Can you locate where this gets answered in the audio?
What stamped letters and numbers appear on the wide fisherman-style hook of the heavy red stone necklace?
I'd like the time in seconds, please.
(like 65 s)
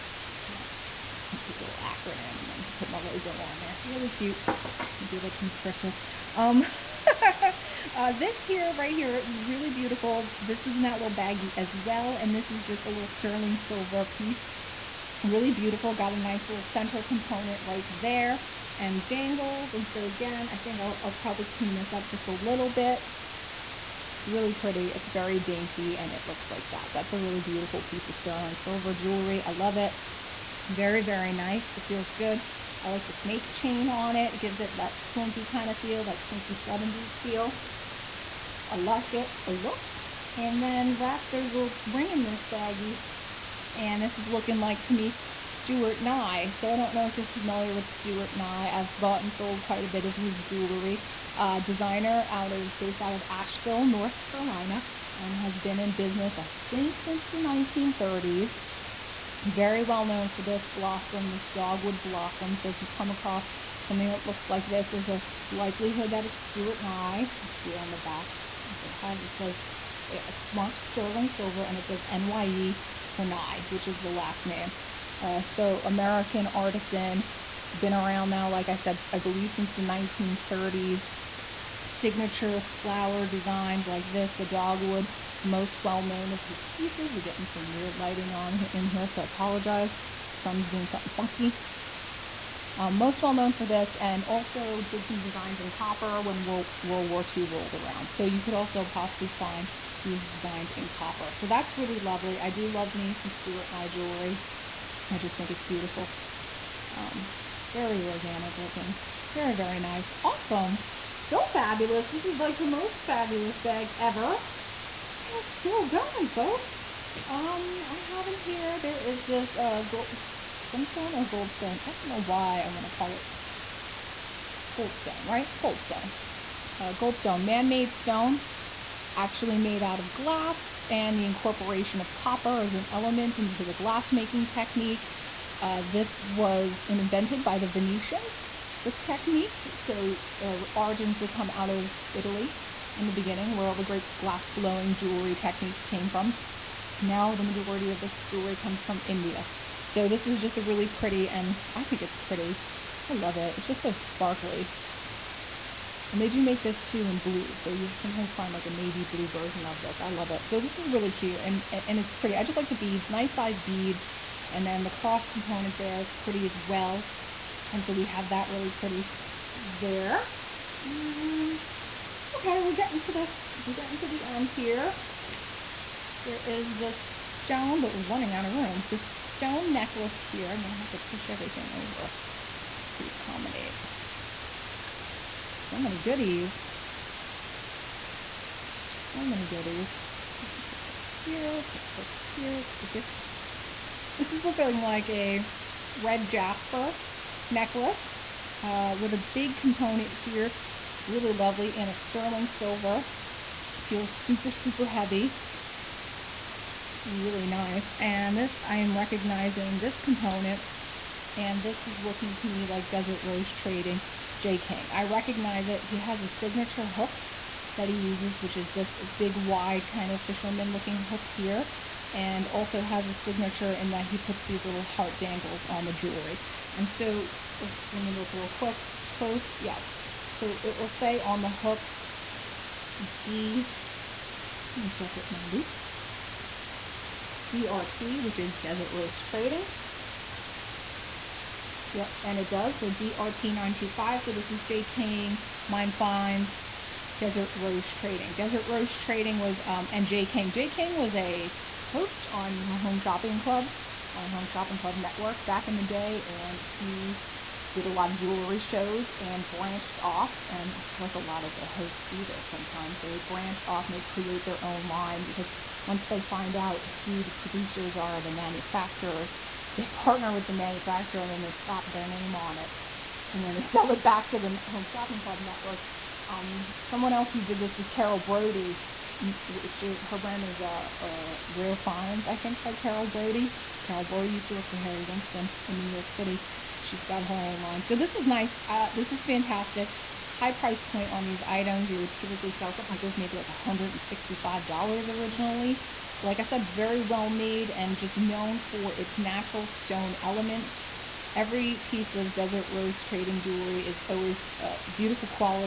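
242 s.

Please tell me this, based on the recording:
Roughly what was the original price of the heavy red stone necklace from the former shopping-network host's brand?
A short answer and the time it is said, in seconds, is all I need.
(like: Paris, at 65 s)
$165, at 293 s.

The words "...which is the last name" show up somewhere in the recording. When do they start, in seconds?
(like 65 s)
73 s.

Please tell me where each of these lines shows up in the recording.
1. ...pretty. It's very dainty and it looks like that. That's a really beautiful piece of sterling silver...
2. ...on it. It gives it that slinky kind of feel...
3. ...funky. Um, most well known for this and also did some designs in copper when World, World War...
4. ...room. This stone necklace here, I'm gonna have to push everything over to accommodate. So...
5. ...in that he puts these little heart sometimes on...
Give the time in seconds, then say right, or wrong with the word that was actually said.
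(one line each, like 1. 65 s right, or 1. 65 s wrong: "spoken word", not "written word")
1. 24 s right
2. 33 s right
3. 91 s right
4. 178 s right
5. 223 s wrong: "dangles", not "sometimes".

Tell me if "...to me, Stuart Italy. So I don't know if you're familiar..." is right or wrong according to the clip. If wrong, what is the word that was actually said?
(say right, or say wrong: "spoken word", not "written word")
wrong: "Nye", not "Italy".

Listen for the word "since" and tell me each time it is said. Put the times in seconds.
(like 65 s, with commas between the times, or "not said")
57 s, 79 s.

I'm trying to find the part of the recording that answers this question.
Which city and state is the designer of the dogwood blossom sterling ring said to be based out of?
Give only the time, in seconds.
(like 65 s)
53 s.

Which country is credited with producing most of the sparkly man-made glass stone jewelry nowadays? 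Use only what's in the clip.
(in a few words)
India.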